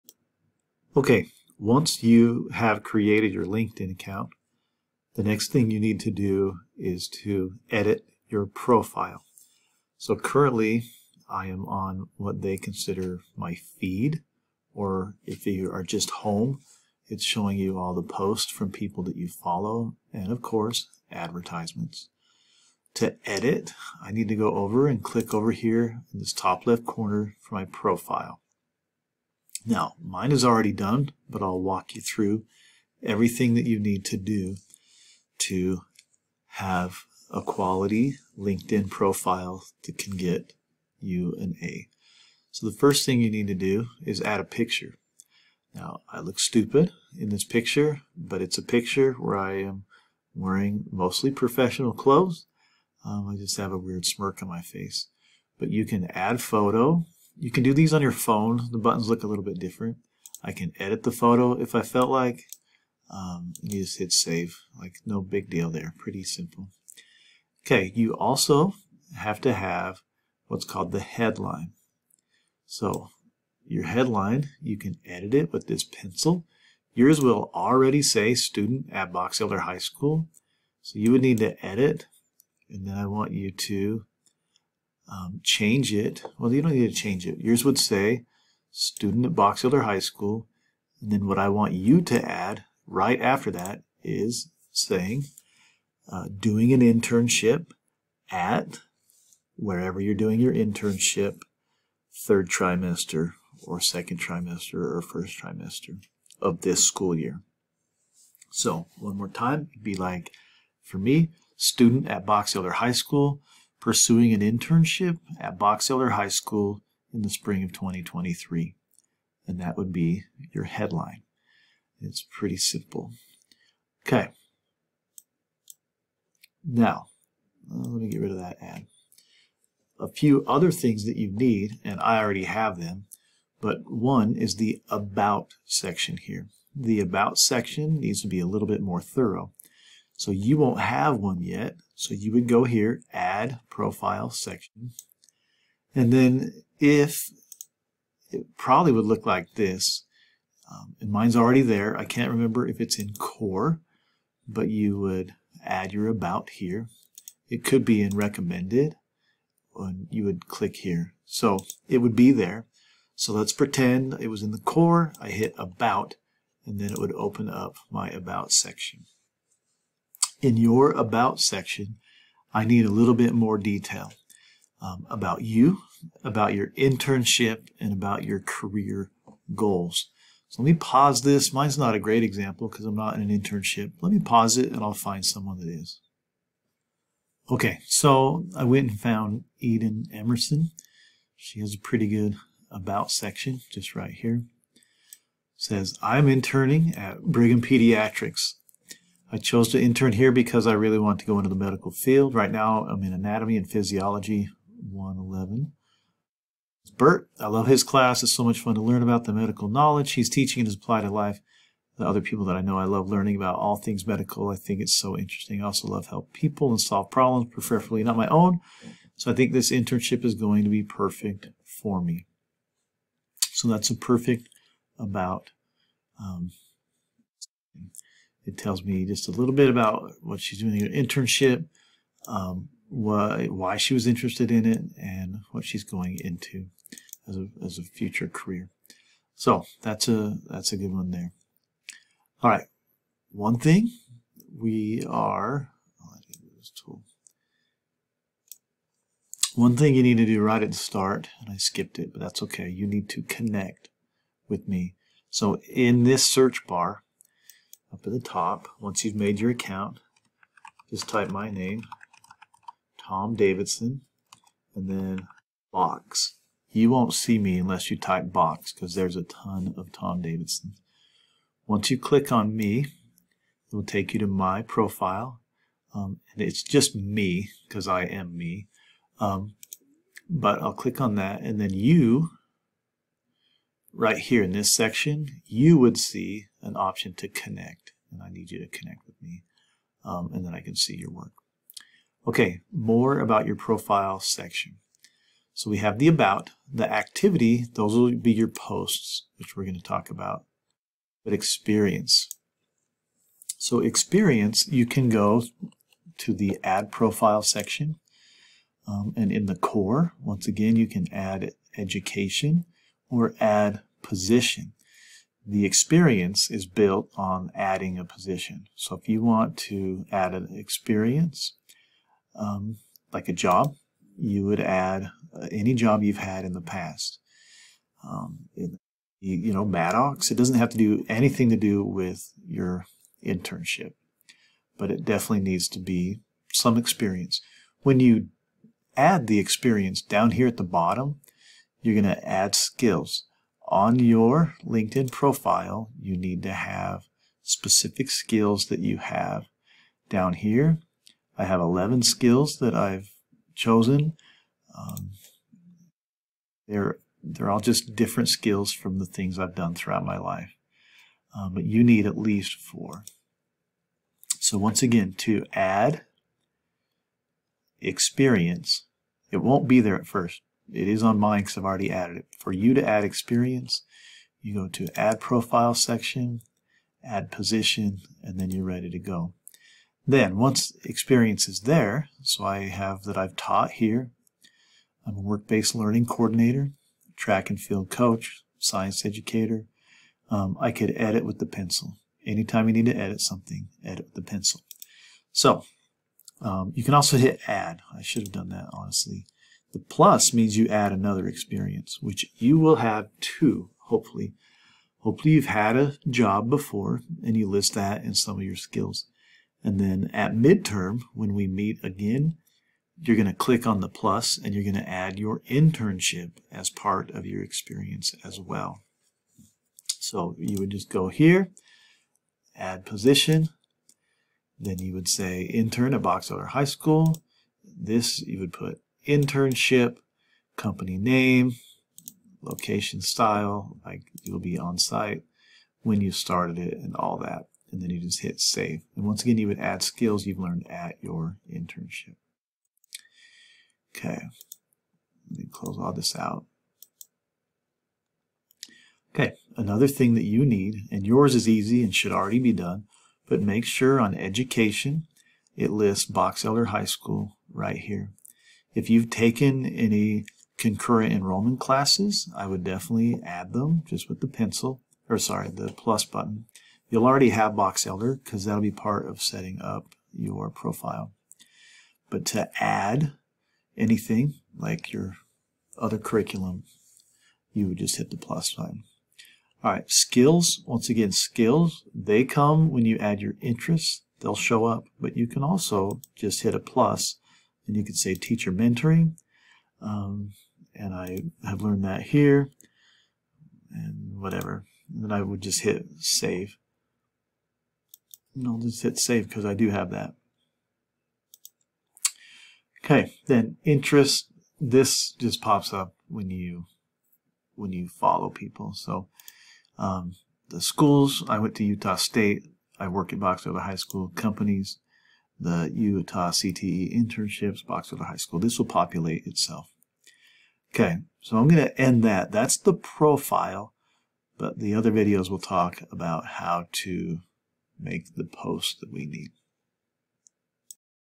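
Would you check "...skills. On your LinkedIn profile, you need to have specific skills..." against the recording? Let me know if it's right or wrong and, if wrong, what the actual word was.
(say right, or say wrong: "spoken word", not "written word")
right.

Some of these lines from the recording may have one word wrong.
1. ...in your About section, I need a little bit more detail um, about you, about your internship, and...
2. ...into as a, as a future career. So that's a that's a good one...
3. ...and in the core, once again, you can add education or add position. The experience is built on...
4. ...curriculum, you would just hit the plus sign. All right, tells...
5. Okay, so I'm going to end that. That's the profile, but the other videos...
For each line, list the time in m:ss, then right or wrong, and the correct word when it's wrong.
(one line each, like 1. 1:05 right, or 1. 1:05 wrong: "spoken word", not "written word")
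1. 2:50 right
2. 3:56 right
3. 5:09 right
4. 7:55 wrong: "skills", not "tells"
5. 8:40 right.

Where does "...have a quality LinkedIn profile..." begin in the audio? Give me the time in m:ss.
0:36.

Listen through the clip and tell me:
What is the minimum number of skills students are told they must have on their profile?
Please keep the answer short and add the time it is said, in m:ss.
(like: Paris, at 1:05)
4, at 6:02.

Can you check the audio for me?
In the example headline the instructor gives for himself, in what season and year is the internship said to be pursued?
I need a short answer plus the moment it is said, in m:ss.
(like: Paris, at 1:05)
spring of 2023, at 1:57.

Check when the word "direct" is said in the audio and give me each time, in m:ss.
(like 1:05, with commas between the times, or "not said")
not said.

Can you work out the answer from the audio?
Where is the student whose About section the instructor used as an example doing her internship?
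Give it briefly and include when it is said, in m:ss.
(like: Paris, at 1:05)
Brigham Pediatrics, at 3:17.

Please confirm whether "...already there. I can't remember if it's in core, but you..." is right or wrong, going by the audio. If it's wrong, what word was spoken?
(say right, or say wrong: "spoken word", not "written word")
right.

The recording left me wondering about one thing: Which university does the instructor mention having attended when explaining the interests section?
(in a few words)
Utah State.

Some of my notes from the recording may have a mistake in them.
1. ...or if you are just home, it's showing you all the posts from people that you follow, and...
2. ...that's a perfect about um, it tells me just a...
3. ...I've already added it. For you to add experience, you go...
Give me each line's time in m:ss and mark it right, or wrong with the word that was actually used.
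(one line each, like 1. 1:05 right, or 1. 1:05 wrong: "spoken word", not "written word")
1. 0:14 right
2. 3:43 right
3. 6:11 right.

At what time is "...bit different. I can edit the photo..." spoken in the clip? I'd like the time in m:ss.
0:59.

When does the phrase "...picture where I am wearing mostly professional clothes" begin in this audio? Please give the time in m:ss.
0:48.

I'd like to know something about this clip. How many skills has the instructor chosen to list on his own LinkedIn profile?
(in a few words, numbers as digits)
11.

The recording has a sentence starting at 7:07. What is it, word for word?
This you would put internship, company name, location style, like you'll be on site, when you started it, and all that.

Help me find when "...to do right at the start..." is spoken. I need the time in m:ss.
4:10.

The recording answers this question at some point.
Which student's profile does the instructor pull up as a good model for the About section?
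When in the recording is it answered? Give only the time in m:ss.
3:09.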